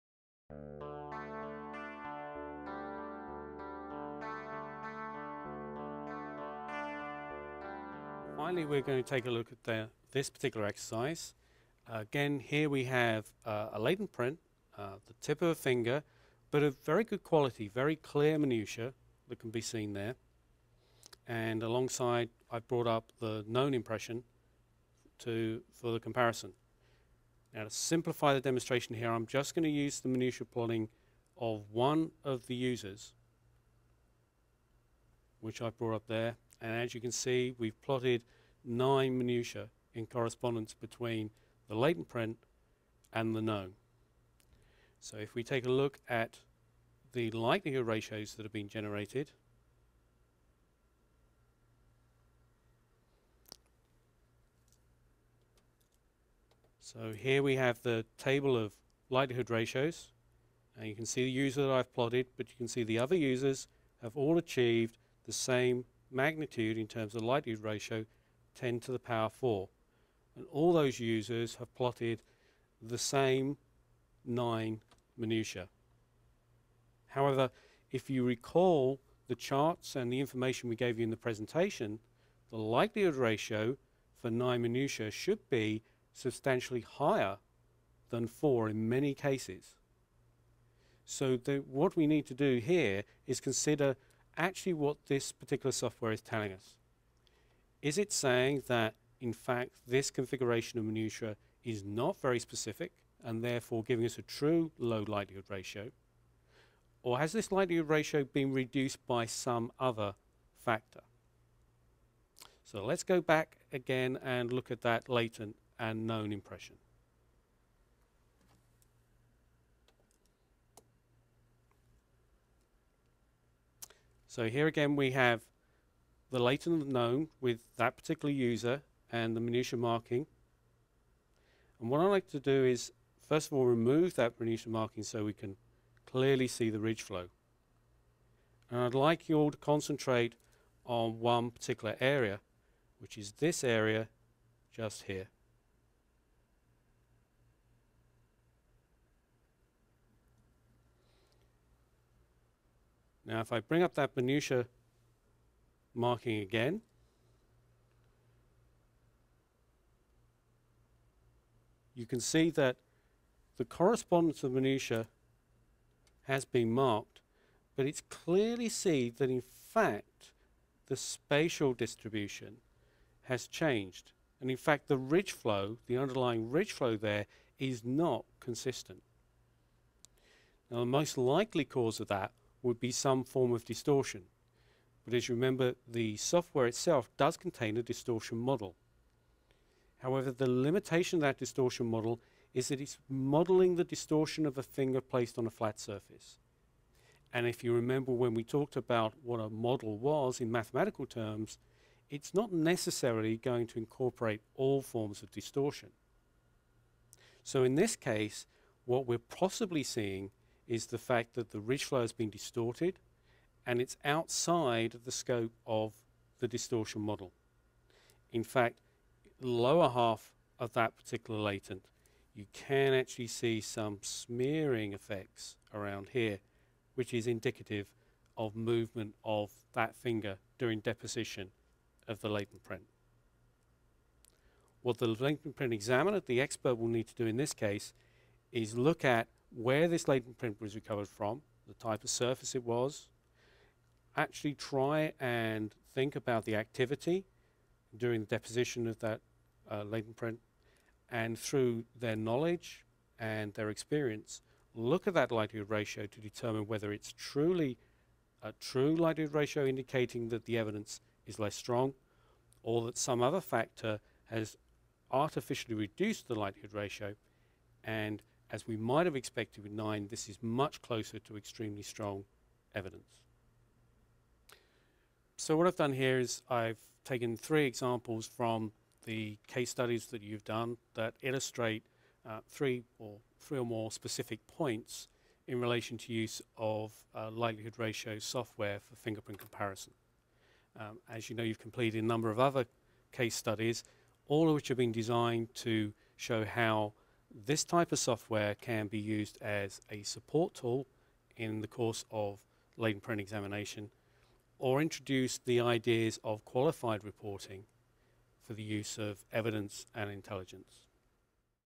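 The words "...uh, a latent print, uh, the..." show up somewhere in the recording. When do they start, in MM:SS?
00:13.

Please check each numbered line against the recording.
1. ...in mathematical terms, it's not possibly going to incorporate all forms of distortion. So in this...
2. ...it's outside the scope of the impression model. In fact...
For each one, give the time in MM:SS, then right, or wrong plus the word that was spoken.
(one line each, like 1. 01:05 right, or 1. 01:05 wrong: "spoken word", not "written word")
1. 03:20 wrong: "necessarily", not "possibly"
2. 03:33 wrong: "distortion", not "impression".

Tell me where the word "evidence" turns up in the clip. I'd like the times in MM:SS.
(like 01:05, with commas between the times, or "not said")
04:20, 04:32, 05:09.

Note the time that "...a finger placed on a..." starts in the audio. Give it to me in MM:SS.
03:14.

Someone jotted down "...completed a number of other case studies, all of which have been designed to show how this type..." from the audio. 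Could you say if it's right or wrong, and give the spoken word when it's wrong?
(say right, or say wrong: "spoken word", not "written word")
right.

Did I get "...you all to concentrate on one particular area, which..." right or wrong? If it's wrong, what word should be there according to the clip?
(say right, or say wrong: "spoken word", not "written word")
right.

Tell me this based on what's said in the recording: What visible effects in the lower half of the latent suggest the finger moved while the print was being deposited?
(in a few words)
smearing effects.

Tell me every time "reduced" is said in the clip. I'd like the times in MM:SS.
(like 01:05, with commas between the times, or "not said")
01:48, 04:25.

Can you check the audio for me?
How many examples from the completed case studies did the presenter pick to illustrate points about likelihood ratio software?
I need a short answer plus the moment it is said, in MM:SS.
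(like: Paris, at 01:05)
3, at 04:37.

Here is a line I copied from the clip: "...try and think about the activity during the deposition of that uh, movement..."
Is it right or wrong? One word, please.
wrong.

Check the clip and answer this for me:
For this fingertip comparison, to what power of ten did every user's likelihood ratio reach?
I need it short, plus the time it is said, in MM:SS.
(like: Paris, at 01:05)
10 to the power 4, at 01:08.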